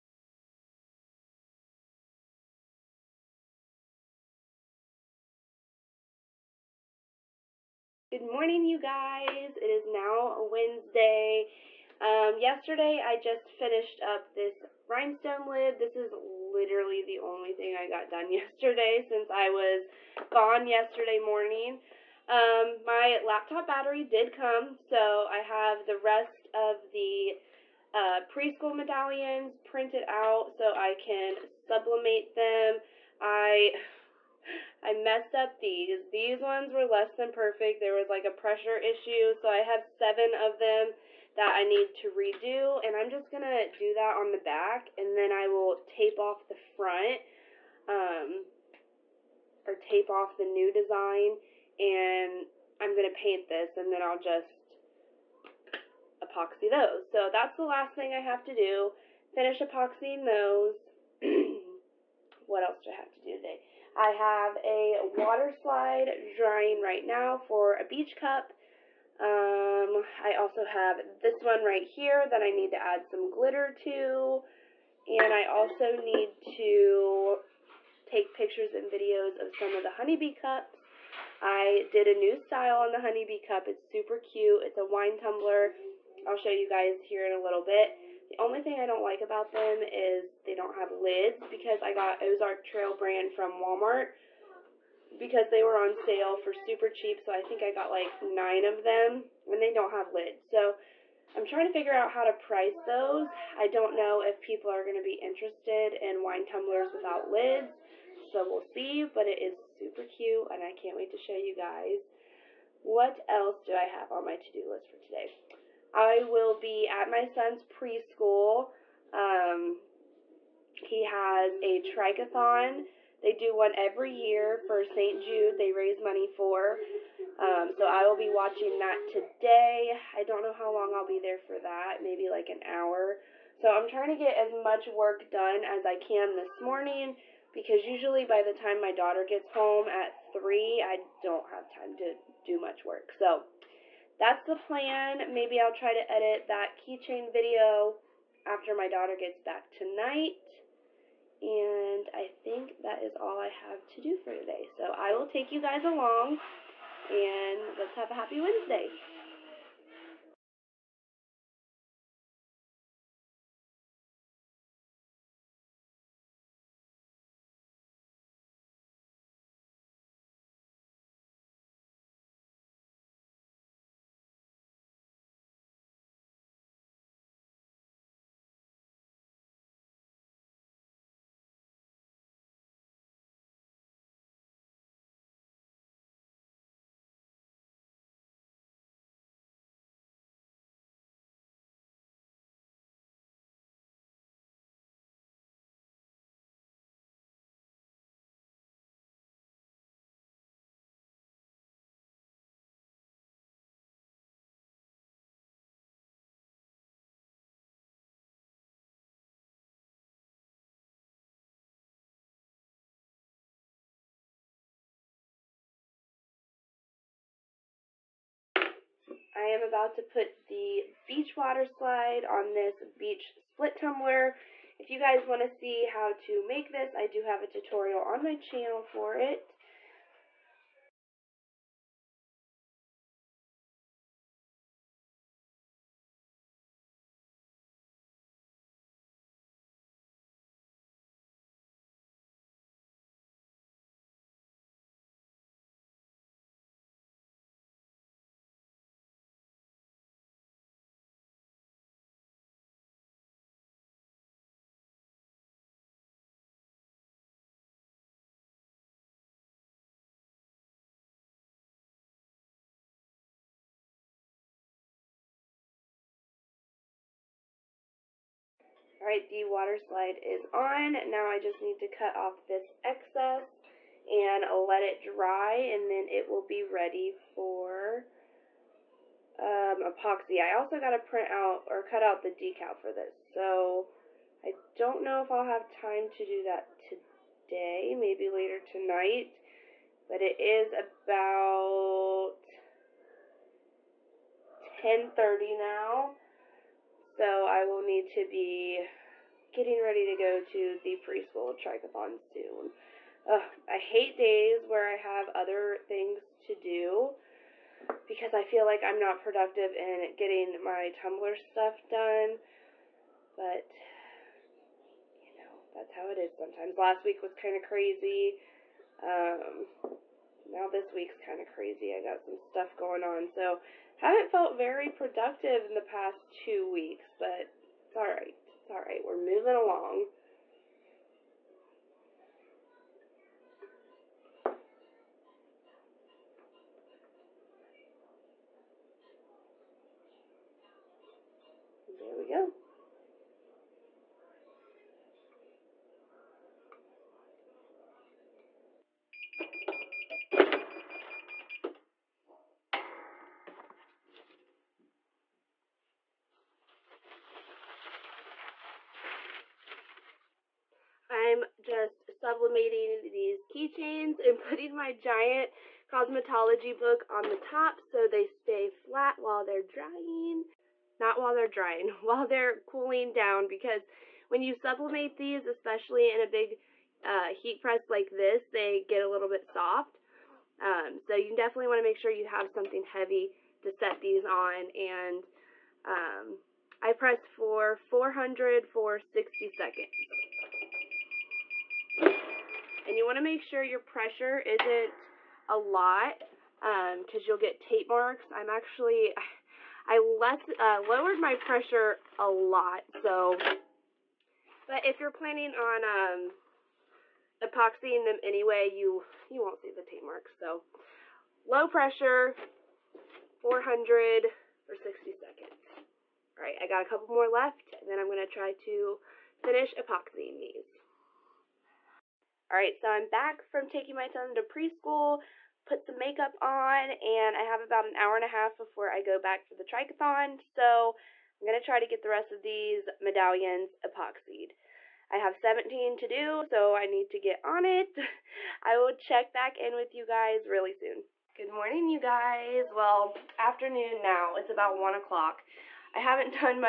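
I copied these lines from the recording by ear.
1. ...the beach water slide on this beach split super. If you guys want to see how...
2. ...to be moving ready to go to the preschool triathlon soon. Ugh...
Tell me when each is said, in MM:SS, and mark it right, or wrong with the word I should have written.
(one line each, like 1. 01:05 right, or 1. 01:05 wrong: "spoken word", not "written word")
1. 03:40 wrong: "tumbler", not "super"
2. 04:58 wrong: "getting", not "moving".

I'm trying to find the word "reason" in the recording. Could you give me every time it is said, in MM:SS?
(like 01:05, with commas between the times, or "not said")
not said.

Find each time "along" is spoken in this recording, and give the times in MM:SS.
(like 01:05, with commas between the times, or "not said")
02:35, 05:29.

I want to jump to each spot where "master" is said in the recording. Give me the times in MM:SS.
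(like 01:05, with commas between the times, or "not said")
not said.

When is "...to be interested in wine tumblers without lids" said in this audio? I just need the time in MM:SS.
01:44.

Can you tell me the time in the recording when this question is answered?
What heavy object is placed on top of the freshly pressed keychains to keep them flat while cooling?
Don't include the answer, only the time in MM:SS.
06:05.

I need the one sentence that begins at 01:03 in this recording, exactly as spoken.
I have a water slide drying right now for a beach cup.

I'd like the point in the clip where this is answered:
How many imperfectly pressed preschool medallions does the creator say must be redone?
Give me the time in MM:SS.
00:39.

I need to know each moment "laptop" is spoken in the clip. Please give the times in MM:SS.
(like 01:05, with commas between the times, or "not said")
00:23.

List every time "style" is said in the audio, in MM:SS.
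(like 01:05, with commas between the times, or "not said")
01:22.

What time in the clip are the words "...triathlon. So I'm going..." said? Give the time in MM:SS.
07:09.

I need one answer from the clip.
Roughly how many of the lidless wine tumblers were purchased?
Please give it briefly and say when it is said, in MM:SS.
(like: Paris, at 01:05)
9, at 01:38.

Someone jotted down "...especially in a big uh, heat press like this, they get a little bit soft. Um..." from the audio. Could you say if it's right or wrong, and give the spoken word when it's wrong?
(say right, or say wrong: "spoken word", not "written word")
right.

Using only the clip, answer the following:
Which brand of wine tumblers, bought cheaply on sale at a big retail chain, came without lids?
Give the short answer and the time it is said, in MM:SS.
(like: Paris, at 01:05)
Ozark Trail, at 01:32.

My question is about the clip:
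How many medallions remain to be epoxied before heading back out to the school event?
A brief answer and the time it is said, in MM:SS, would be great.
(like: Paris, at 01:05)
17, at 07:15.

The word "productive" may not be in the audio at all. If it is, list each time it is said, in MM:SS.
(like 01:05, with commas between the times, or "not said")
05:09, 05:24.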